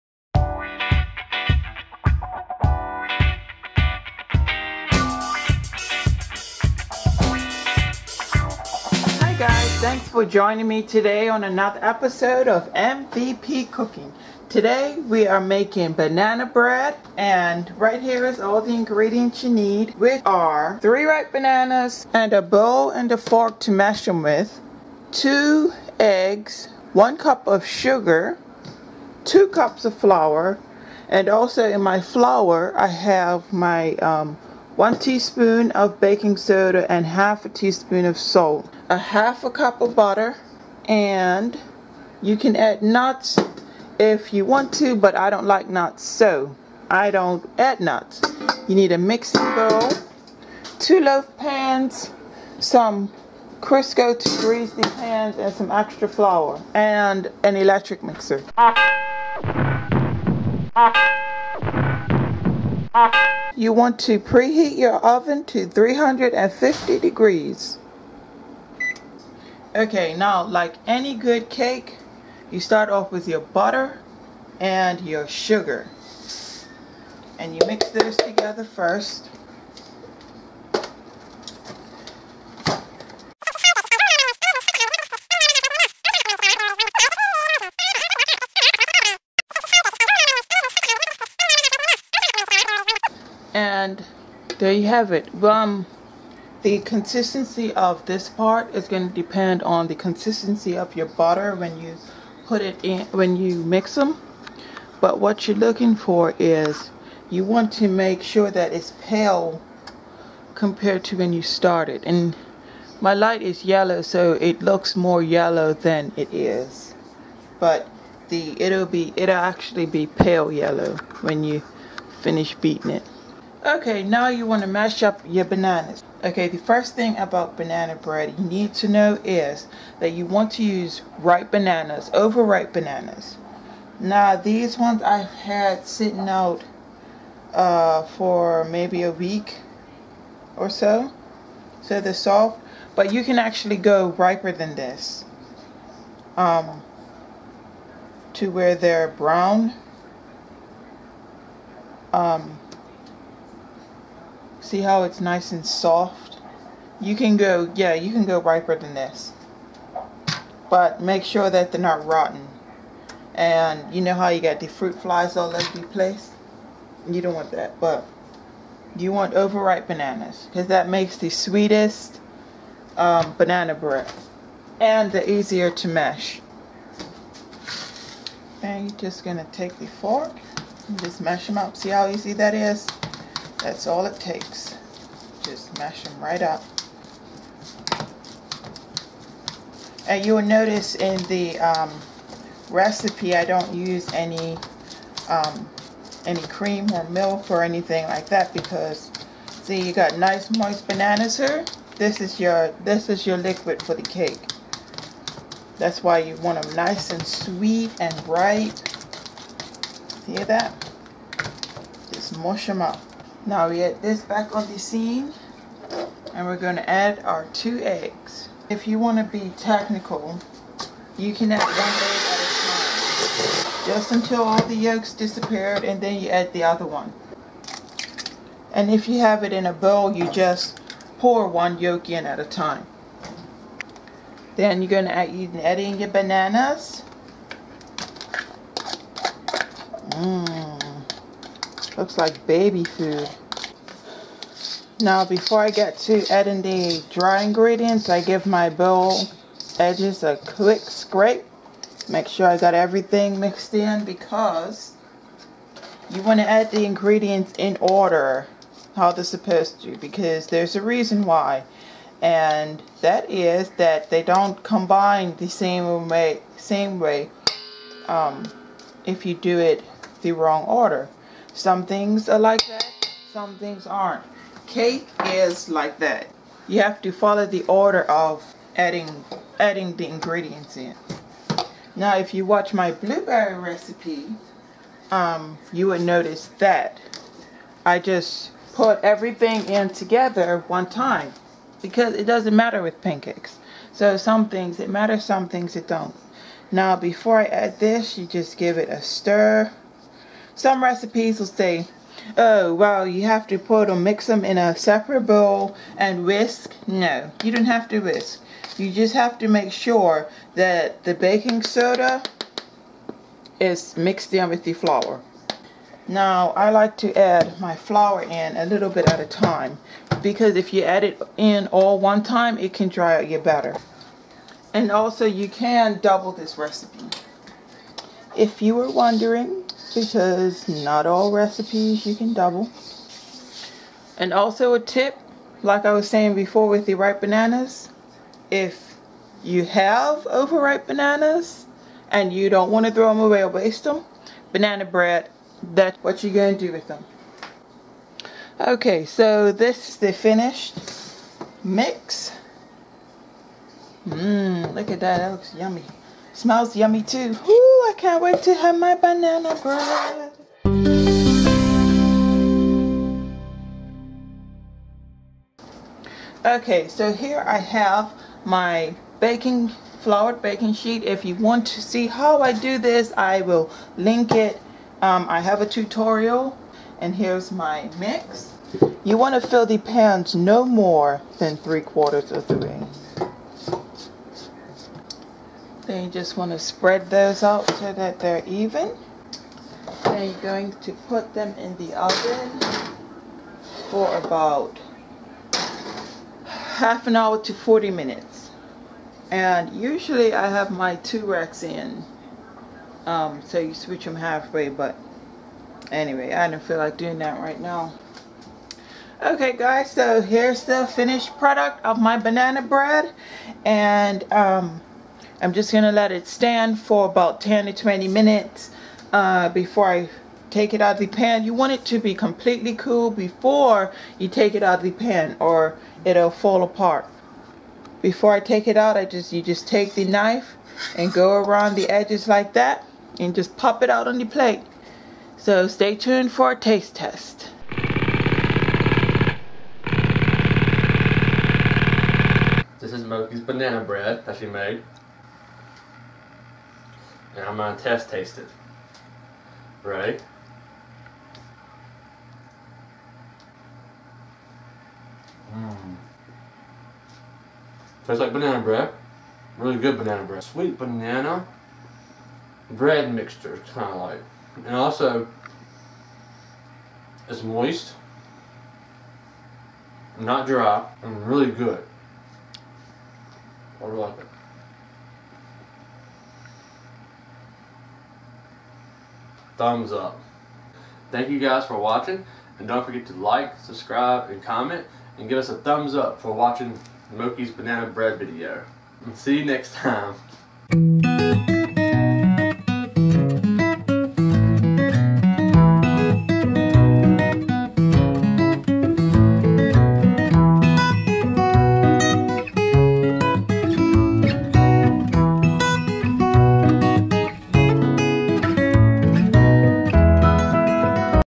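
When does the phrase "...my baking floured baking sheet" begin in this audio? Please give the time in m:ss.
6:08.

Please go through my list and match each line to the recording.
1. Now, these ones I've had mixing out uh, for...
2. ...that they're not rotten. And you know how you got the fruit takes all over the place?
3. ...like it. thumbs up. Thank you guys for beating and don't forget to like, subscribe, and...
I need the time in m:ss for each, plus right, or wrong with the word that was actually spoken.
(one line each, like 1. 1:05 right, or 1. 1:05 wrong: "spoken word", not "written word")
1. 2:13 wrong: "sitting", not "mixing"
2. 2:41 wrong: "flies", not "takes"
3. 7:53 wrong: "watching", not "beating".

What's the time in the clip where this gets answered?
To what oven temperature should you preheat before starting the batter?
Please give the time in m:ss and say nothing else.
1:05.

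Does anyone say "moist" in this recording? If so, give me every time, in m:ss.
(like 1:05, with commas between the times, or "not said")
3:20, 7:47.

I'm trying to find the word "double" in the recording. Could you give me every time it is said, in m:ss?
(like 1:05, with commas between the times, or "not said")
5:26, 5:32.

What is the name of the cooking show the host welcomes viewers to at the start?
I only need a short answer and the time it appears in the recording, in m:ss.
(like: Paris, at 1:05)
MVP Cooking, at 0:12.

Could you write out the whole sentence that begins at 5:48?
Okay, so this is the finished mix.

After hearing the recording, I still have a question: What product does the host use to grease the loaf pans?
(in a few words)
Crisco.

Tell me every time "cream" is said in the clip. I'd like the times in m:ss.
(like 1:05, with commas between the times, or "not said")
3:16.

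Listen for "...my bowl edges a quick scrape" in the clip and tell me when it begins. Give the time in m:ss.
4:08.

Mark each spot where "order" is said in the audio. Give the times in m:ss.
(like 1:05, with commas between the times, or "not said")
4:17, 4:30, 4:37.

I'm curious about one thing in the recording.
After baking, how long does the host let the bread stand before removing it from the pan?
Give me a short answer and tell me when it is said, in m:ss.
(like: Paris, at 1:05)
10 to 20 minutes, at 6:57.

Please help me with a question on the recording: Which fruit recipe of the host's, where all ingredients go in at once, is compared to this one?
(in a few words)
blueberry.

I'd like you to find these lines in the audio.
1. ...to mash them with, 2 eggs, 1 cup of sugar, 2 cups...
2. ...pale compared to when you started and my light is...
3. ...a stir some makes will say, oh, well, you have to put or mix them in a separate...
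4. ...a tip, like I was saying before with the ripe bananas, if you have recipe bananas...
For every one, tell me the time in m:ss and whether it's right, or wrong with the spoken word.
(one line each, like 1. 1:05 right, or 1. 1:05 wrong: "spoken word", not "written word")
1. 0:23 right
2. 1:49 right
3. 4:58 wrong: "recipes", not "makes"
4. 5:34 wrong: "overripe", not "recipe".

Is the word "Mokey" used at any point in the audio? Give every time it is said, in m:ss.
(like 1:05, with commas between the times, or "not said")
7:23, 8:07.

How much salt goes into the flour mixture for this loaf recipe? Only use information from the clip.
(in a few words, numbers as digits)
half a teaspoon.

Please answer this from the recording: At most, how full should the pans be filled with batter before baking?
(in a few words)
three quarters.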